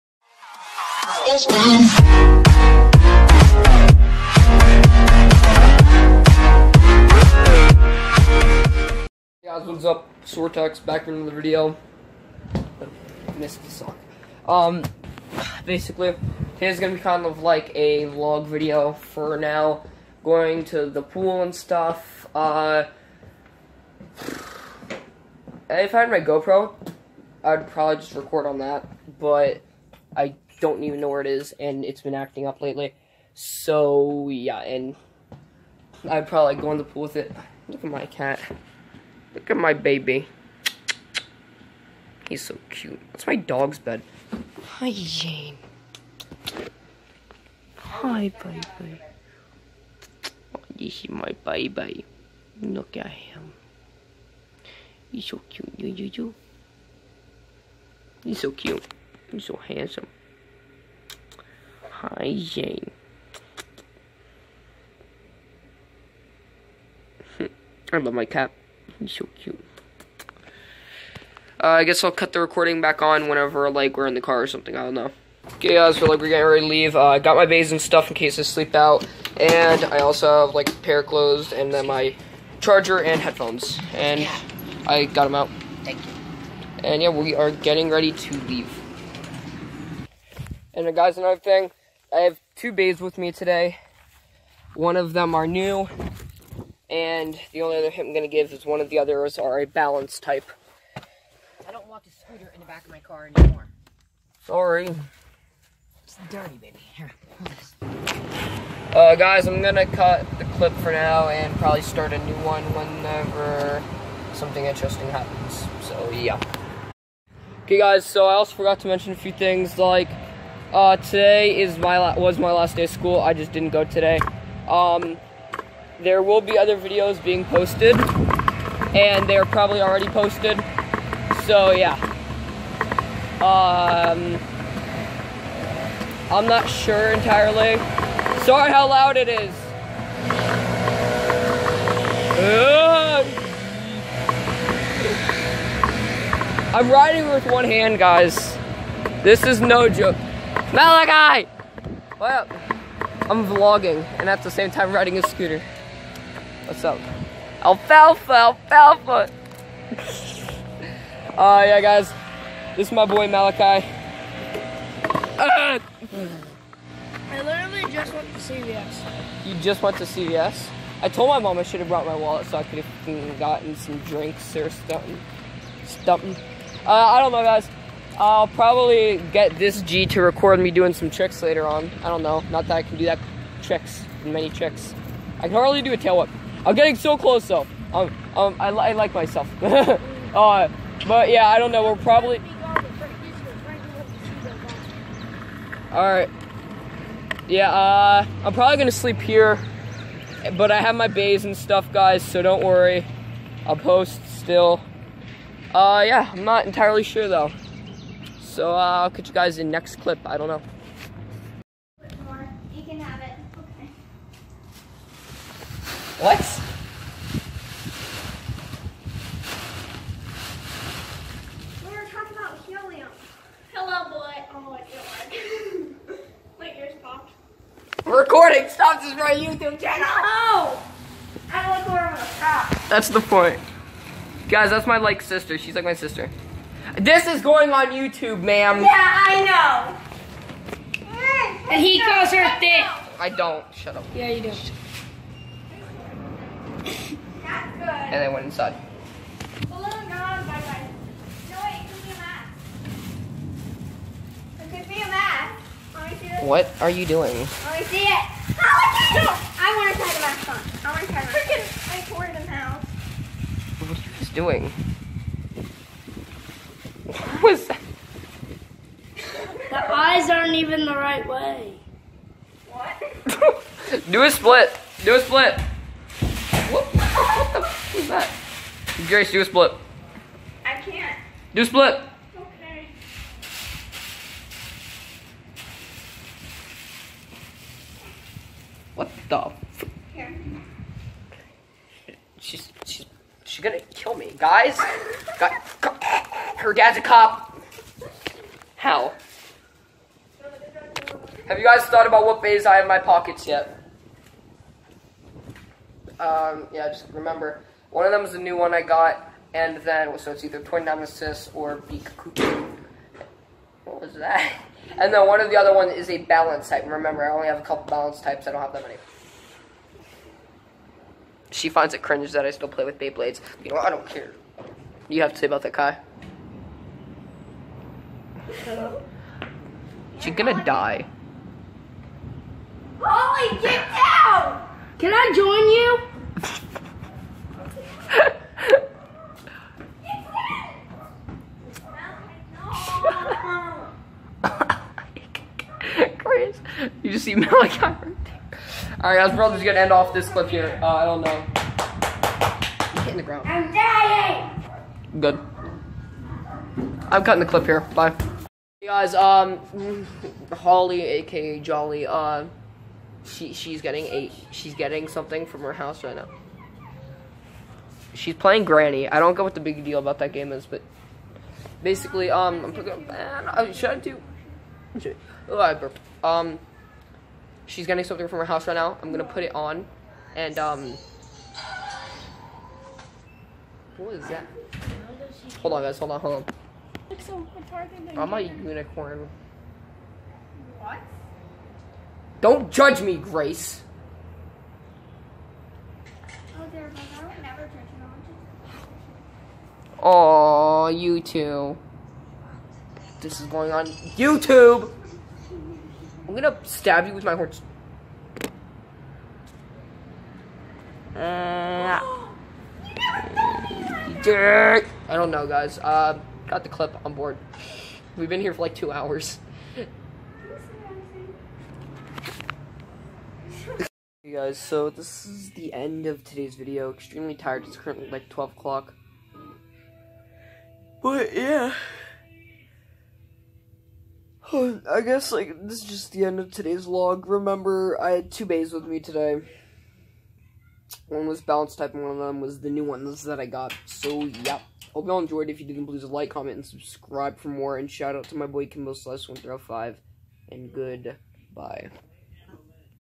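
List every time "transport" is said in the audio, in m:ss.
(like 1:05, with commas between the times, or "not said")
not said.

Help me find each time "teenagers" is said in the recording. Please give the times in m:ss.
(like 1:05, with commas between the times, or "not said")
not said.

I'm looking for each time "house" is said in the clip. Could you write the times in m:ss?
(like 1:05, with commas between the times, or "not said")
6:05, 6:18.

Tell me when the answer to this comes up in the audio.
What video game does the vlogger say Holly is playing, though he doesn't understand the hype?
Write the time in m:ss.
6:08.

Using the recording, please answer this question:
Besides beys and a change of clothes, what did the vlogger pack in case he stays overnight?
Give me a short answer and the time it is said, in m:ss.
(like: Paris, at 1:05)
charger, at 1:22.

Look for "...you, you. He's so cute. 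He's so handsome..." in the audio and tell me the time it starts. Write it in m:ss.
0:55.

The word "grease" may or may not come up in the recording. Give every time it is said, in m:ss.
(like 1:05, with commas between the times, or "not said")
not said.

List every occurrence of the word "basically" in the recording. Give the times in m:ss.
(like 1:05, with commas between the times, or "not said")
0:15, 6:11.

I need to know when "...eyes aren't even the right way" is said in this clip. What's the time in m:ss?
4:29.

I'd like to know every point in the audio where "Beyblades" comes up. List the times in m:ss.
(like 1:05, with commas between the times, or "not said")
5:22.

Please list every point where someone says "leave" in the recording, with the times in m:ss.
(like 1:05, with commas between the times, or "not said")
1:16, 1:28.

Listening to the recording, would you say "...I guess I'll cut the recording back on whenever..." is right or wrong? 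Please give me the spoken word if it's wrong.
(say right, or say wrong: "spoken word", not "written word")
right.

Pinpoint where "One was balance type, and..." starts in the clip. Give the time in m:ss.
7:21.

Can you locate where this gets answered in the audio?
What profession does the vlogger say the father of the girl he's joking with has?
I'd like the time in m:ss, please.
4:57.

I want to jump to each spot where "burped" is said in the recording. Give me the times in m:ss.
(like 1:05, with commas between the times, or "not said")
6:15.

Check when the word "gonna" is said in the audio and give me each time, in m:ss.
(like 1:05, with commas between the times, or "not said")
0:16, 3:18, 4:53, 5:30, 5:49, 6:19, 6:46.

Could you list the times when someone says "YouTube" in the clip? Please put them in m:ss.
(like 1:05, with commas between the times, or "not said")
3:49, 3:57, 6:43.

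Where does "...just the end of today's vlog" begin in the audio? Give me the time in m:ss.
7:15.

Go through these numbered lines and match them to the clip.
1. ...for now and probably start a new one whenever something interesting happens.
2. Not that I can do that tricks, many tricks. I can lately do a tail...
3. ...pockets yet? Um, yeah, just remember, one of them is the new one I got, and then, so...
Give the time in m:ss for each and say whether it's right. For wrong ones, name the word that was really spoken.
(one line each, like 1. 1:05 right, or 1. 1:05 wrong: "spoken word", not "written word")
1. 1:50 right
2. 3:02 wrong: "hardly", not "lately"
3. 5:02 right.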